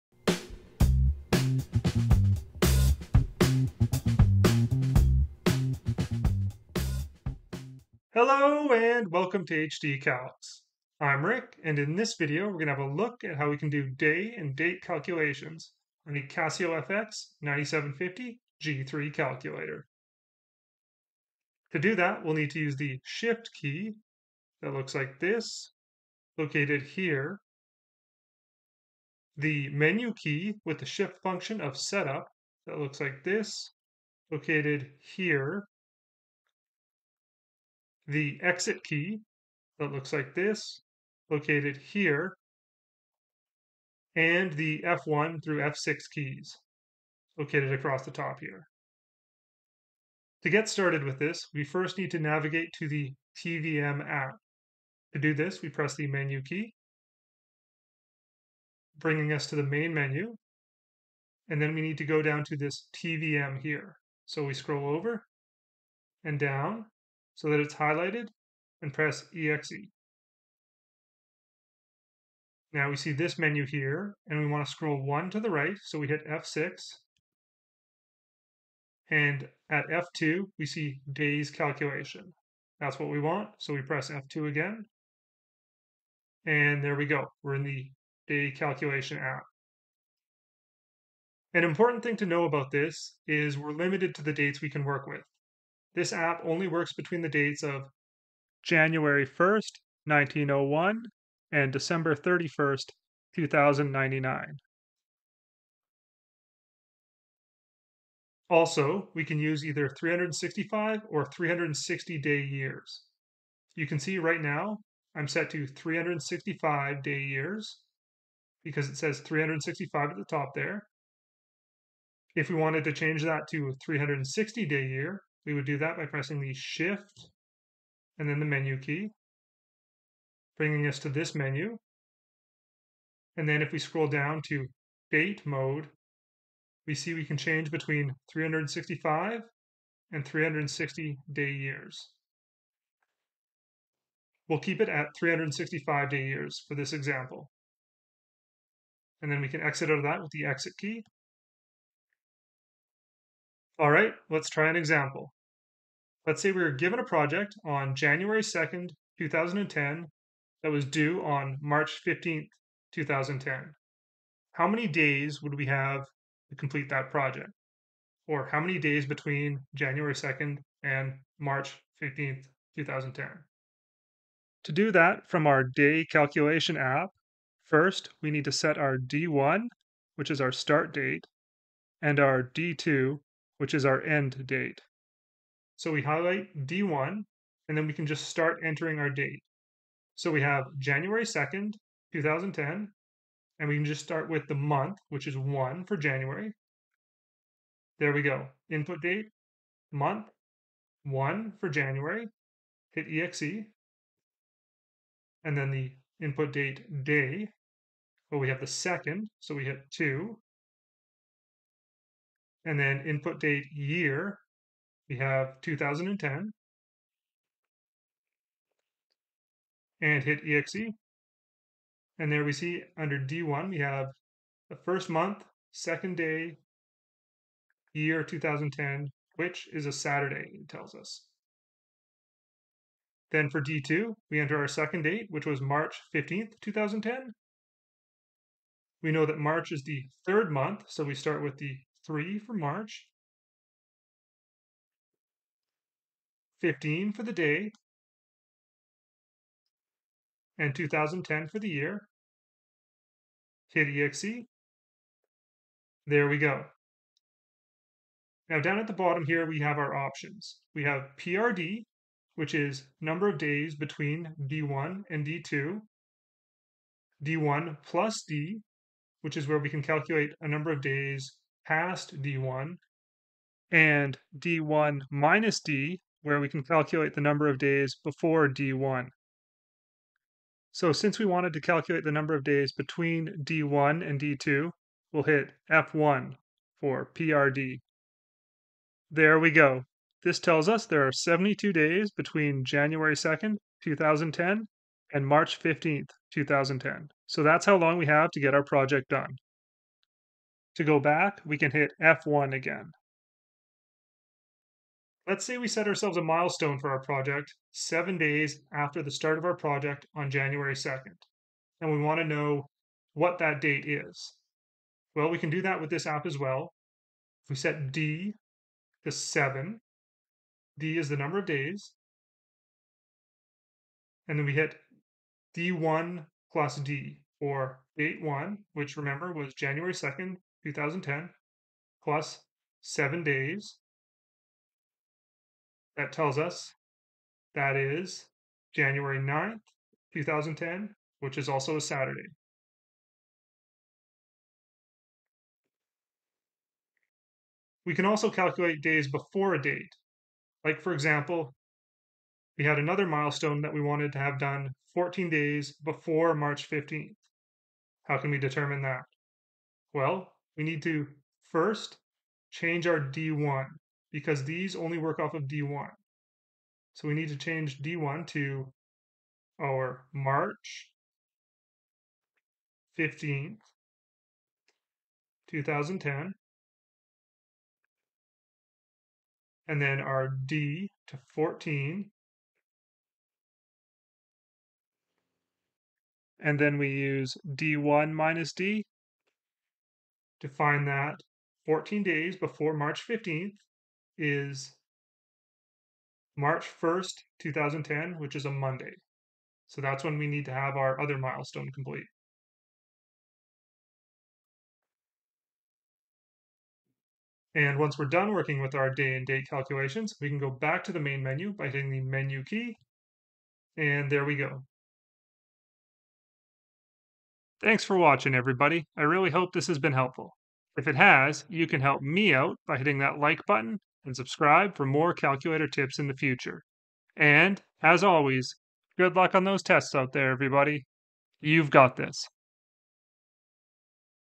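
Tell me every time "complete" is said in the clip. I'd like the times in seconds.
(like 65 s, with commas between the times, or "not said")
166 s, 401 s.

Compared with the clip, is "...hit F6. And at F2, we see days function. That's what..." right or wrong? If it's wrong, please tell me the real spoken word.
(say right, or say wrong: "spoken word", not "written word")
wrong: "calculation", not "function".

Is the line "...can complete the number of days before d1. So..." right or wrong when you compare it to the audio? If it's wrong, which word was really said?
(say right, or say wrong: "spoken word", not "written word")
wrong: "calculate", not "complete".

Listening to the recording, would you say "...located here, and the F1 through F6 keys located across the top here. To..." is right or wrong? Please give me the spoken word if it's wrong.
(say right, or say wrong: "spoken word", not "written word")
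right.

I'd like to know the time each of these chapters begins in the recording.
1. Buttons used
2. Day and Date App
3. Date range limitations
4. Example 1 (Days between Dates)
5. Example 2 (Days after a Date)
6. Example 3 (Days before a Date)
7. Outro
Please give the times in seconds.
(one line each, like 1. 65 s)
1. 20 s
2. 49 s
3. 91 s
4. 156 s
5. 304 s
6. 347 s
7. 415 s.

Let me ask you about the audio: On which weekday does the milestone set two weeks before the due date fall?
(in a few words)
Monday.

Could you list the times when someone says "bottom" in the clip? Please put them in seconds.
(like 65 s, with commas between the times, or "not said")
258 s.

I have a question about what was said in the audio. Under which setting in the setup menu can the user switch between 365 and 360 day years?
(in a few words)
Date mode.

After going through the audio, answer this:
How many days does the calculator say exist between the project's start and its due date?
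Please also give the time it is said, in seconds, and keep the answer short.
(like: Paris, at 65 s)
72, at 291 s.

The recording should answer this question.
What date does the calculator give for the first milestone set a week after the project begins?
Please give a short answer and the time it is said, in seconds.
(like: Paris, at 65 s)
January 9th, 2010, at 338 s.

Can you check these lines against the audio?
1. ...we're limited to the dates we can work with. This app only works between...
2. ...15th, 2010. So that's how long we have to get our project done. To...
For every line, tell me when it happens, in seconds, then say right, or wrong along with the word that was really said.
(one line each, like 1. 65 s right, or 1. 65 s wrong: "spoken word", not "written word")
1. 93 s right
2. 295 s right.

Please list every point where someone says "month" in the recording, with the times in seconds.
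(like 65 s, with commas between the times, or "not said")
194 s, 199 s, 225 s, 240 s.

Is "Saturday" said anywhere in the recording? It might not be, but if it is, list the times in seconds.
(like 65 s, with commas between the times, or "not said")
229 s, 341 s.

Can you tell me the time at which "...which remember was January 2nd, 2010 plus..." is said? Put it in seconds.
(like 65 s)
328 s.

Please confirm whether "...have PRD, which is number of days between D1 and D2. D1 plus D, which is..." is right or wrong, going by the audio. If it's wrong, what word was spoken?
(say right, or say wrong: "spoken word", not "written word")
right.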